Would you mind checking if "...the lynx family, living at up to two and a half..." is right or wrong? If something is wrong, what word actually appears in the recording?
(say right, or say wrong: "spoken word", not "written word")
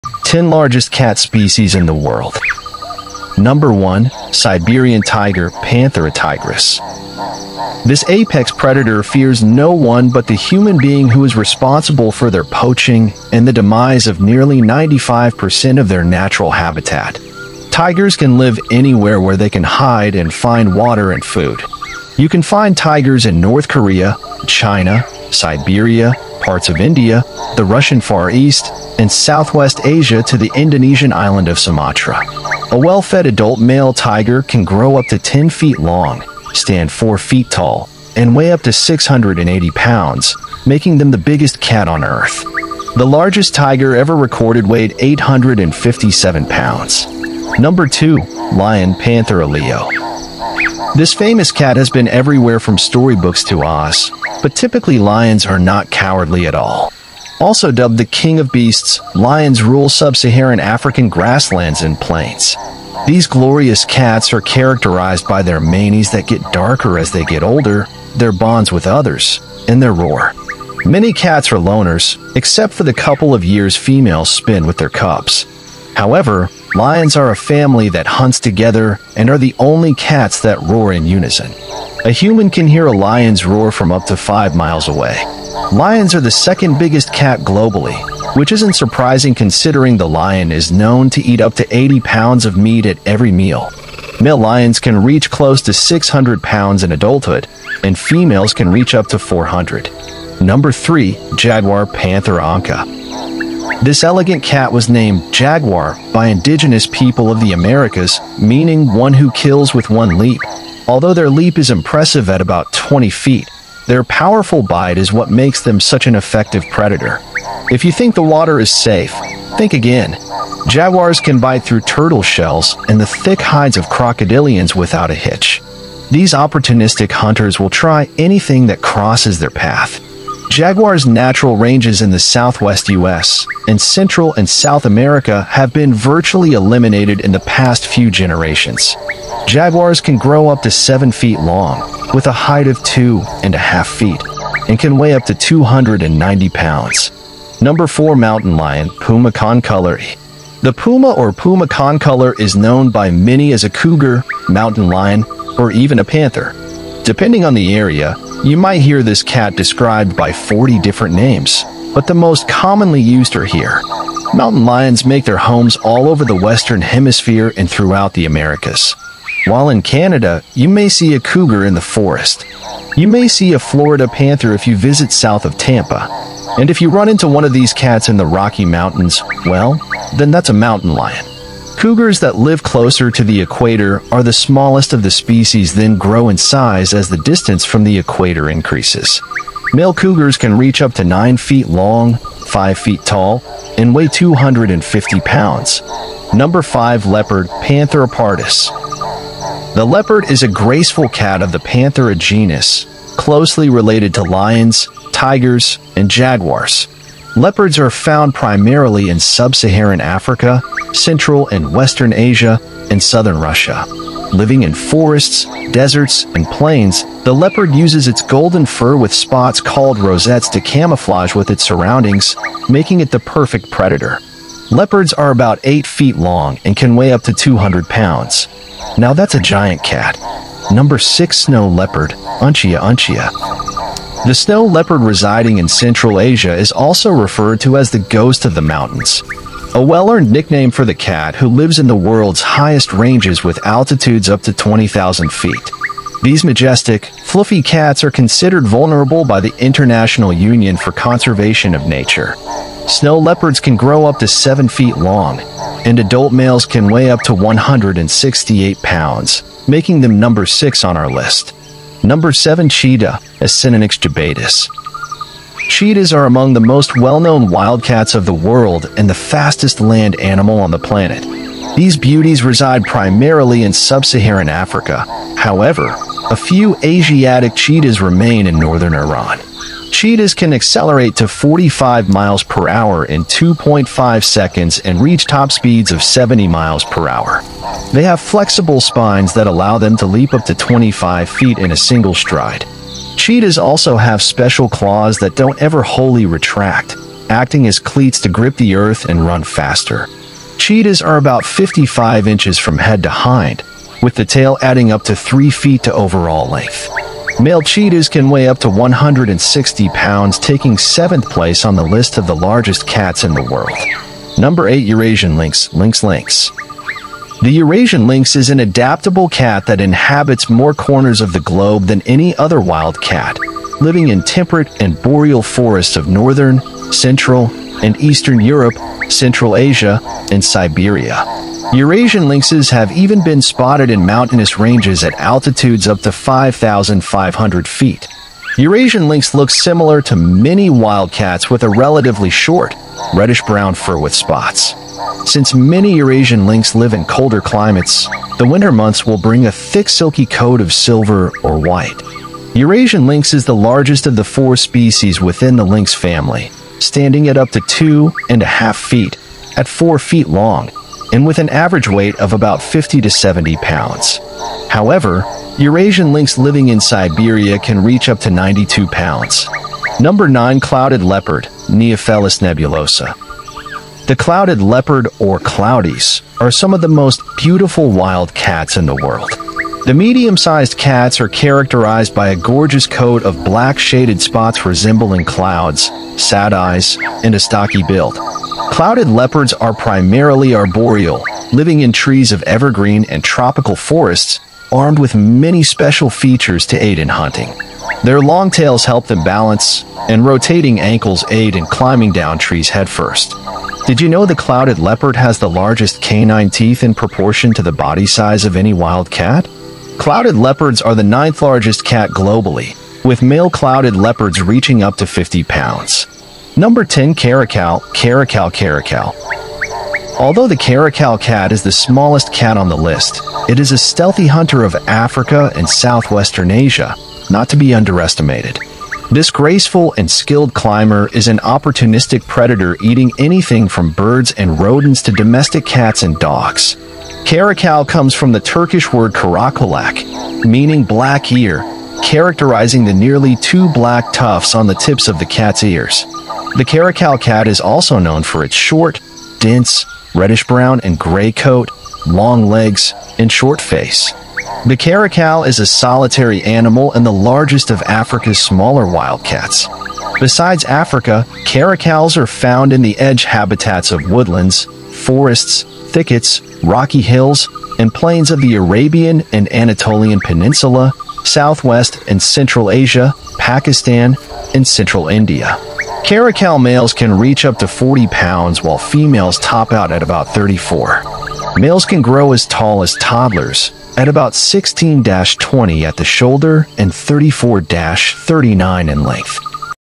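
wrong: "standing", not "living".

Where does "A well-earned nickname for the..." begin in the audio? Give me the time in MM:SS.
03:59.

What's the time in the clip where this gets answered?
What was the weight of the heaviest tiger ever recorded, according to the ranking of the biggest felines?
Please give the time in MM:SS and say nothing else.
00:44.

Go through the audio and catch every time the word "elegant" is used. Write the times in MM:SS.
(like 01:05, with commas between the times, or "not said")
01:44.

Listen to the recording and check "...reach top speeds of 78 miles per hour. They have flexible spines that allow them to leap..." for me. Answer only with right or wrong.
wrong.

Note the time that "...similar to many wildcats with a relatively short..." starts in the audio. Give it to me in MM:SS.
05:39.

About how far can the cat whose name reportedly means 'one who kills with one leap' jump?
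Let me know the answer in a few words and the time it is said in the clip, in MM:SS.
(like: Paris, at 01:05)
20 feet, at 01:52.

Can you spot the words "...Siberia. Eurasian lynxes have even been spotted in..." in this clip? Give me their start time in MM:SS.
05:30.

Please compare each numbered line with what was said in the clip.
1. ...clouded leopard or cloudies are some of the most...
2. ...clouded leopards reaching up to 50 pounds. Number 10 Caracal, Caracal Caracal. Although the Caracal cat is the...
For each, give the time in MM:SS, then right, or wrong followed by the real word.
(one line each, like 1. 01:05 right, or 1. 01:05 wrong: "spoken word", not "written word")
1. 06:14 right
2. 06:53 right.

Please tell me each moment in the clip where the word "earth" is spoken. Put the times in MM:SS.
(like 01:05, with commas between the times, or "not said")
00:42, 04:58.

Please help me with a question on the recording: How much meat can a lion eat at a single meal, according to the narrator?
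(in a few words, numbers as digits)
80 pounds.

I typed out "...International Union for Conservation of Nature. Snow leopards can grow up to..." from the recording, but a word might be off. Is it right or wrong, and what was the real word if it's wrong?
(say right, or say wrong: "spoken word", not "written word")
right.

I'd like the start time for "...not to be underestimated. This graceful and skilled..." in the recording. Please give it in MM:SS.
07:07.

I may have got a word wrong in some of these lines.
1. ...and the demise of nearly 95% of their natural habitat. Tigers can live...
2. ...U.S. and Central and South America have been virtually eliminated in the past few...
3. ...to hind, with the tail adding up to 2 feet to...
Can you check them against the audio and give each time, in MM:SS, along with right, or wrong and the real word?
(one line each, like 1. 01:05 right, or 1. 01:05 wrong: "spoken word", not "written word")
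1. 00:13 right
2. 02:12 right
3. 05:03 wrong: "3", not "2".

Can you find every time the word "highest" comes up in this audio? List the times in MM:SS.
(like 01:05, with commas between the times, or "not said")
04:02.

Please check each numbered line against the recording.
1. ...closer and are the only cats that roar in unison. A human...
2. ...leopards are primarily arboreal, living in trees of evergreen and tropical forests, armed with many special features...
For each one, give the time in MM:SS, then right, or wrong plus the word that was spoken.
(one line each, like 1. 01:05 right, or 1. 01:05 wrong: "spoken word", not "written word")
1. 01:18 wrong: "together", not "closer"
2. 06:29 right.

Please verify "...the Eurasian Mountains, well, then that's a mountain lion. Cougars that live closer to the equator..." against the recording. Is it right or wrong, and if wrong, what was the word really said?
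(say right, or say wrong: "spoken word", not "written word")
wrong: "Rocky", not "Eurasian".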